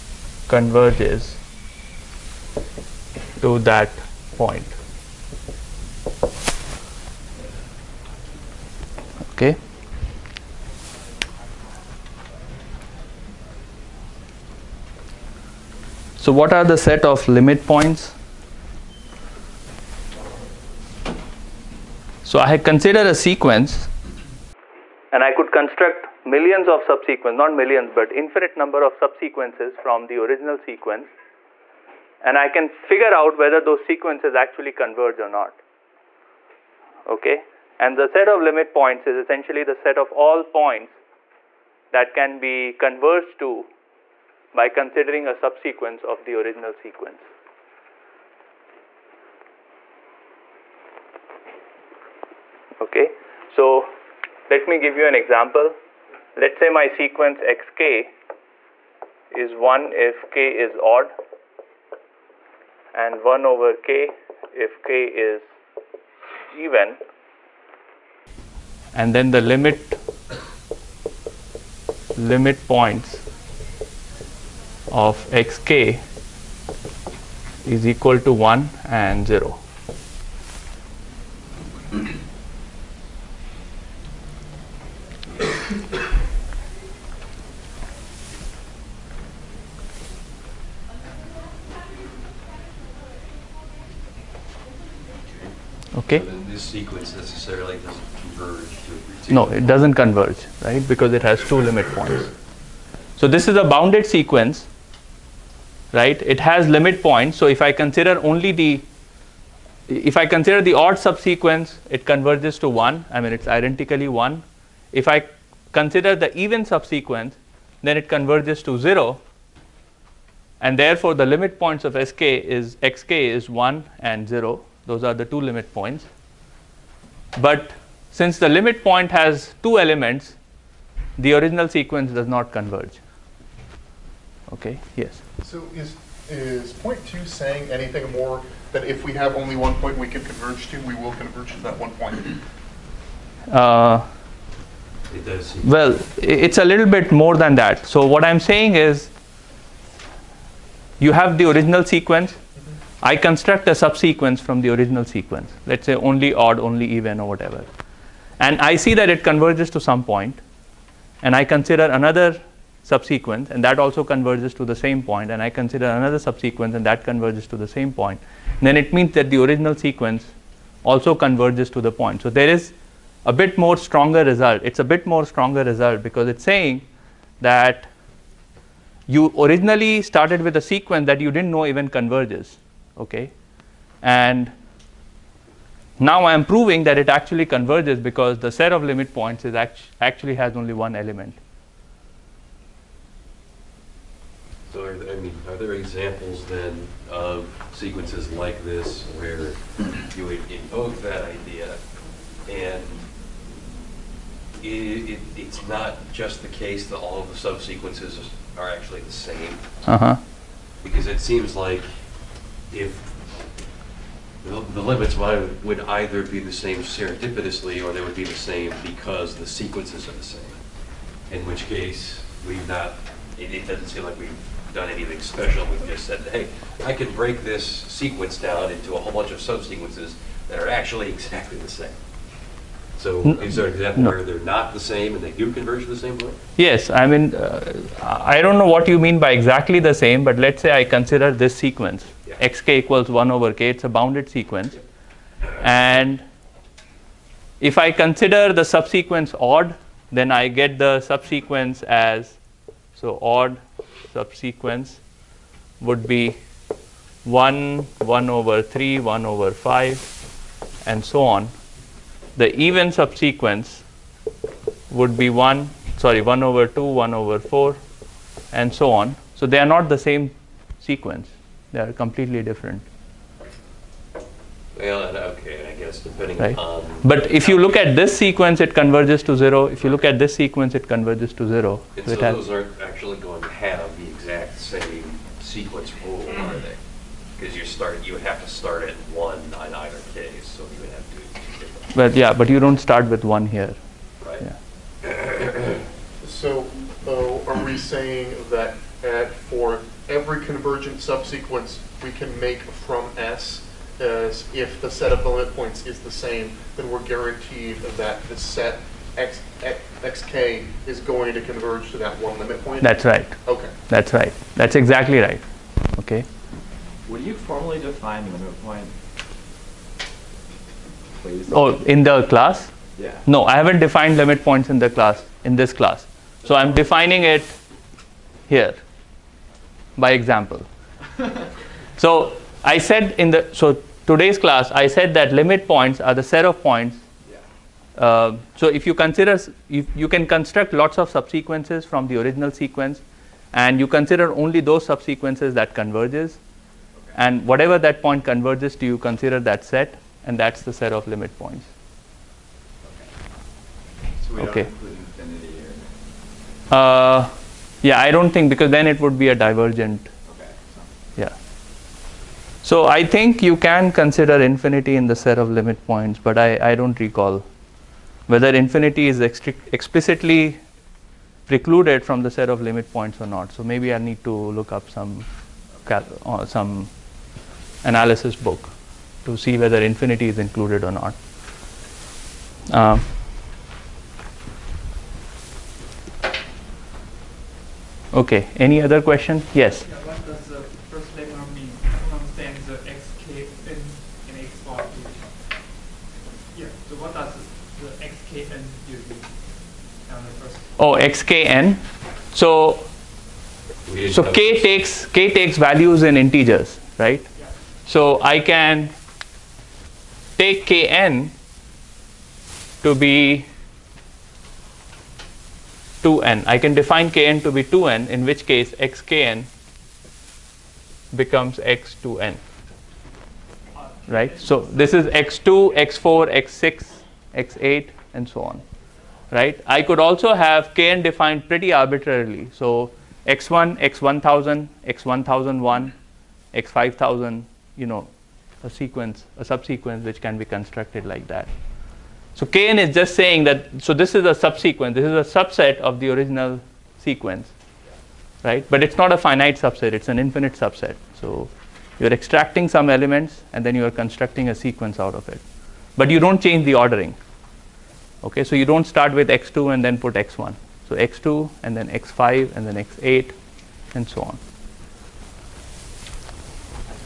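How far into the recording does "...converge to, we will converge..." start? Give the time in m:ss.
2:20.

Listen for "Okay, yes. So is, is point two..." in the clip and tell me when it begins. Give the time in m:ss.
2:14.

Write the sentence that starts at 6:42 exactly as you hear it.
So so k takes k takes values in integers, right?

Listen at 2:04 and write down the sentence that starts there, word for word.
Those are the two limit points.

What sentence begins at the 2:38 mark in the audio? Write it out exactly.
And I see that it converges to some point, point.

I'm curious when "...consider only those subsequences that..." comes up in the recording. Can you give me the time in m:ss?
5:43.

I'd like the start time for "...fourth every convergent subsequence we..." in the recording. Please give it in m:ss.
4:59.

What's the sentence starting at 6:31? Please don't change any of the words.
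I don't understand the and, Yeah.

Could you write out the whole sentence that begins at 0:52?
Okay, so let me give you an example.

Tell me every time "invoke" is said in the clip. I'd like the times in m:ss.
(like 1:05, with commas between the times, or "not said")
3:20.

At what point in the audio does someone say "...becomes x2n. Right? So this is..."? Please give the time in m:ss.
7:01.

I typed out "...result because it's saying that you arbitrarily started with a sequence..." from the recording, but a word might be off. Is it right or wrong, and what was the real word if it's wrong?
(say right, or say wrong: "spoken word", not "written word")
wrong: "originally", not "arbitrarily".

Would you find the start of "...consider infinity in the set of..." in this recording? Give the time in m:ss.
6:03.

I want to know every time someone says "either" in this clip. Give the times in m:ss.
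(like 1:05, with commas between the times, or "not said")
3:35, 4:49.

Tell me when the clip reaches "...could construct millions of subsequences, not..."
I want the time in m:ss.
0:25.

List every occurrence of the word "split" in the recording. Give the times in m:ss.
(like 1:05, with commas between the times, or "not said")
not said.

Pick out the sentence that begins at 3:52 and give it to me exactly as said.
So is there an example where they're not the same and they do converge to the same point?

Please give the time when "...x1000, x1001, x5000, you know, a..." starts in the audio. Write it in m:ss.
7:13.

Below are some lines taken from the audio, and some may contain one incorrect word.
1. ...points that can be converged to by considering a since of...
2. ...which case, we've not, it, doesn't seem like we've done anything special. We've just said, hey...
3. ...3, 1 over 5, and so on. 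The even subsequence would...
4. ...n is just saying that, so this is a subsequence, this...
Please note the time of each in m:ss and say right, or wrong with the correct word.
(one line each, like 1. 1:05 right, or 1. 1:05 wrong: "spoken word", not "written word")
1. 0:40 wrong: "subsequence", not "since"
2. 3:41 right
3. 4:18 right
4. 7:22 right.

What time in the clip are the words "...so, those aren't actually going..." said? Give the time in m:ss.
4:42.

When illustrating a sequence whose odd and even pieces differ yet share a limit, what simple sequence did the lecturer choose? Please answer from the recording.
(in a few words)
1 over k.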